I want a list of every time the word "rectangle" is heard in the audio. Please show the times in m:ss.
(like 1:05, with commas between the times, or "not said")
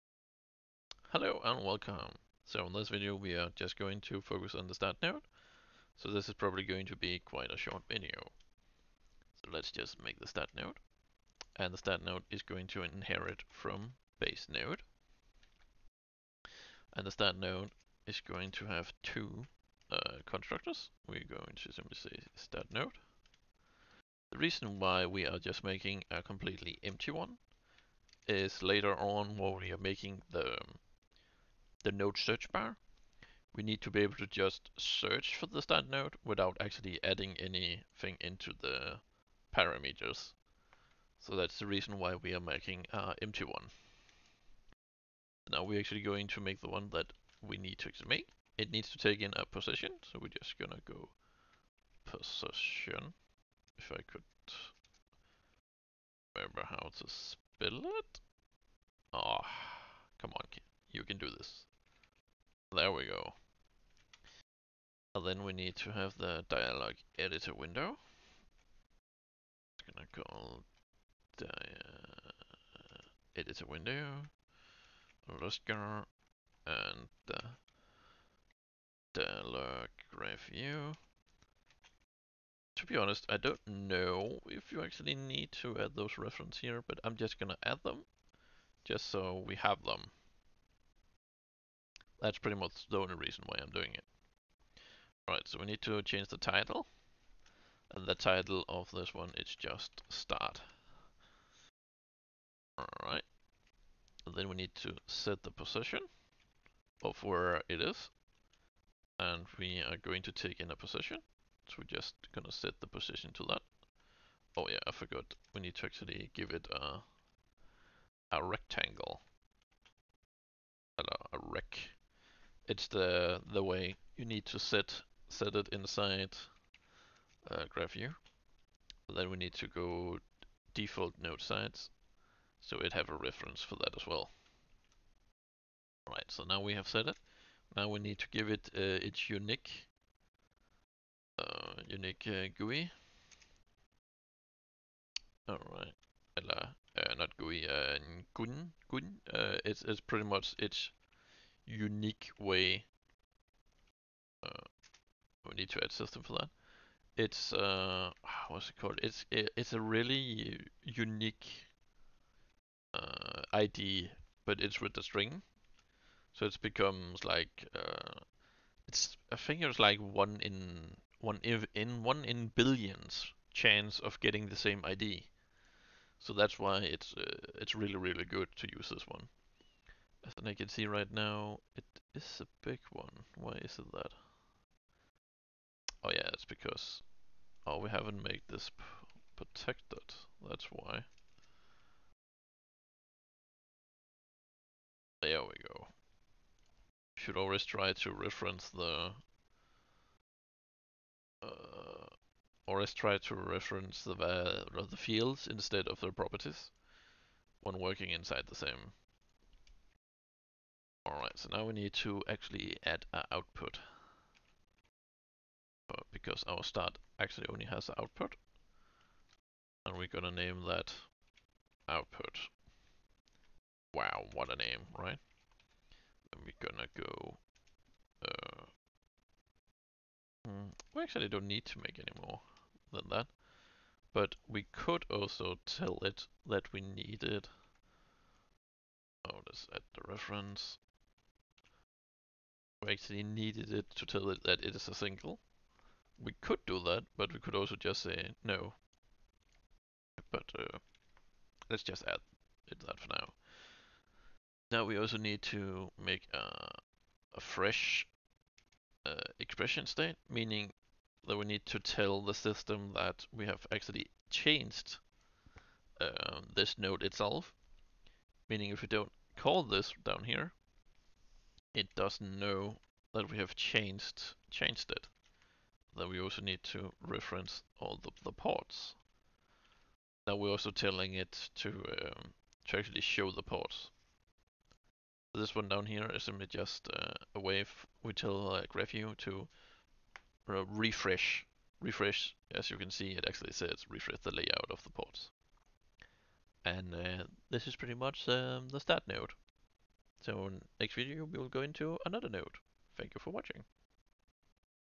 1:58.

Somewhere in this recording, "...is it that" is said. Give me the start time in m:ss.
3:03.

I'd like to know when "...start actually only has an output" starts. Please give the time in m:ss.
3:36.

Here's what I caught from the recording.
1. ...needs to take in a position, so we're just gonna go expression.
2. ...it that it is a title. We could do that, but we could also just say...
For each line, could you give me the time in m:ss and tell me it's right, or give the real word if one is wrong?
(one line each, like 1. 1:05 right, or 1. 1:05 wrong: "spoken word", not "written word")
1. 0:48 wrong: "position", not "expression"
2. 4:04 wrong: "single", not "title".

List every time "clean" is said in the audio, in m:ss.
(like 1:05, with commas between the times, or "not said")
not said.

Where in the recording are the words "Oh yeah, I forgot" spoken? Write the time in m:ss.
1:54.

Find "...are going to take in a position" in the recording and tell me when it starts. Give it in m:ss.
1:49.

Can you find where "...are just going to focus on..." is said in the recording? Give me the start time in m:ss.
0:03.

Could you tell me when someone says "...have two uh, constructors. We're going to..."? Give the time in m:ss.
0:18.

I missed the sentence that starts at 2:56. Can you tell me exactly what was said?
So that's why it's uh, it's really really good to use this one.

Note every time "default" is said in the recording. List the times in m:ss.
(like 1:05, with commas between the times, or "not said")
2:10.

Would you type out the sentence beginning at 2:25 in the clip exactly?
Alright, uh, not GUI, uh, GUID, GUID.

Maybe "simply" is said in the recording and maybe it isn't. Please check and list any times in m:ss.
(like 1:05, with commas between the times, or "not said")
0:21, 4:46.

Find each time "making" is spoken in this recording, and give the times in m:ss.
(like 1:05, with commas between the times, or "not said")
0:25, 0:29, 0:42.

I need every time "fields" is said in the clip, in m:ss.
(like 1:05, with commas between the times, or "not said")
3:24.